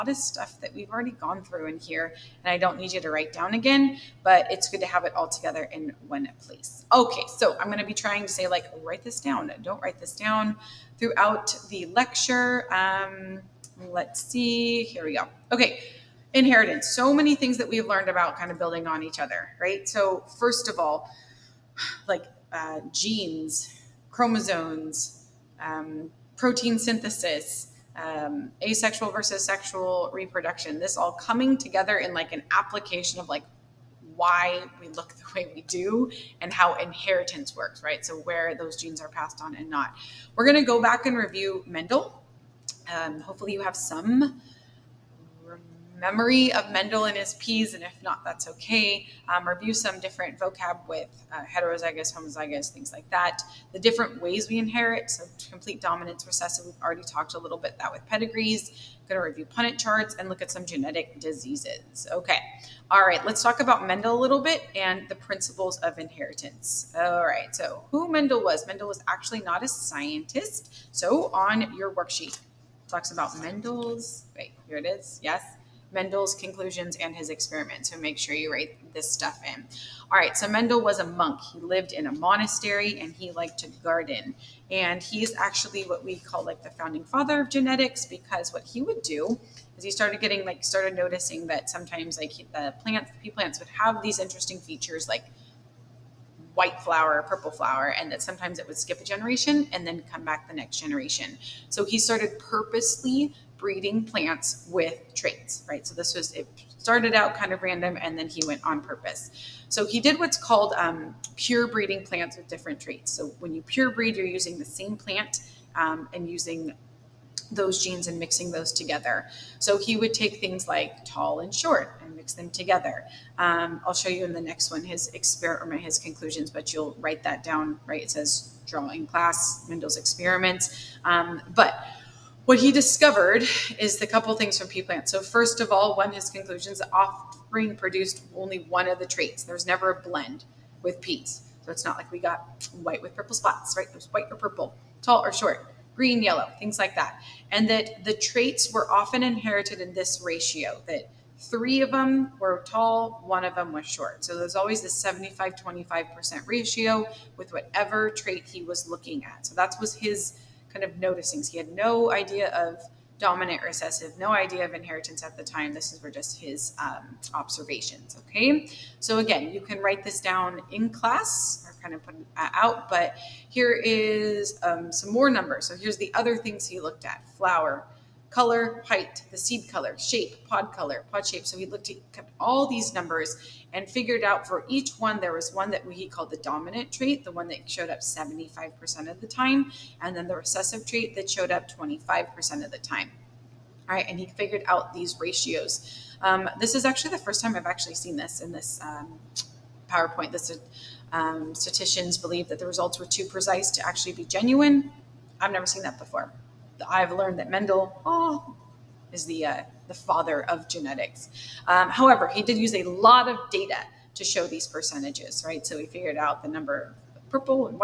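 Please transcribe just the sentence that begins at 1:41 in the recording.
So he started purposely breeding plants with traits, right?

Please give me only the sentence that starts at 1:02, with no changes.
Okay, all right, let's talk about Mendel a little bit and the principles of inheritance.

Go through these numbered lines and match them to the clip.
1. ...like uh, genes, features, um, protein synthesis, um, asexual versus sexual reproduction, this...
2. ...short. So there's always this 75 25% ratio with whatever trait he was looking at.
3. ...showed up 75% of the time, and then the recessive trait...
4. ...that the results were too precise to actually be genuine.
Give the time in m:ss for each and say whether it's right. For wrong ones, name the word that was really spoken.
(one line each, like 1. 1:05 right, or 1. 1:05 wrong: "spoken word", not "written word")
1. 0:22 wrong: "chromosomes", not "features"
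2. 2:33 right
3. 3:07 right
4. 3:22 right.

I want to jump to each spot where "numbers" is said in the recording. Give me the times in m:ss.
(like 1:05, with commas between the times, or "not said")
2:55, 3:02, 3:36.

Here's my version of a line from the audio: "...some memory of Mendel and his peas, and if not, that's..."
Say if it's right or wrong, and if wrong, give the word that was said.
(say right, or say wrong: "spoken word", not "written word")
right.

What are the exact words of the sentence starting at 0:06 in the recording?
Okay, so I'm going to be trying to say like, write this down.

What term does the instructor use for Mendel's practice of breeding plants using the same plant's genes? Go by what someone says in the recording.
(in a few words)
Pure breeding.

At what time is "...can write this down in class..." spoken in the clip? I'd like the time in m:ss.
2:49.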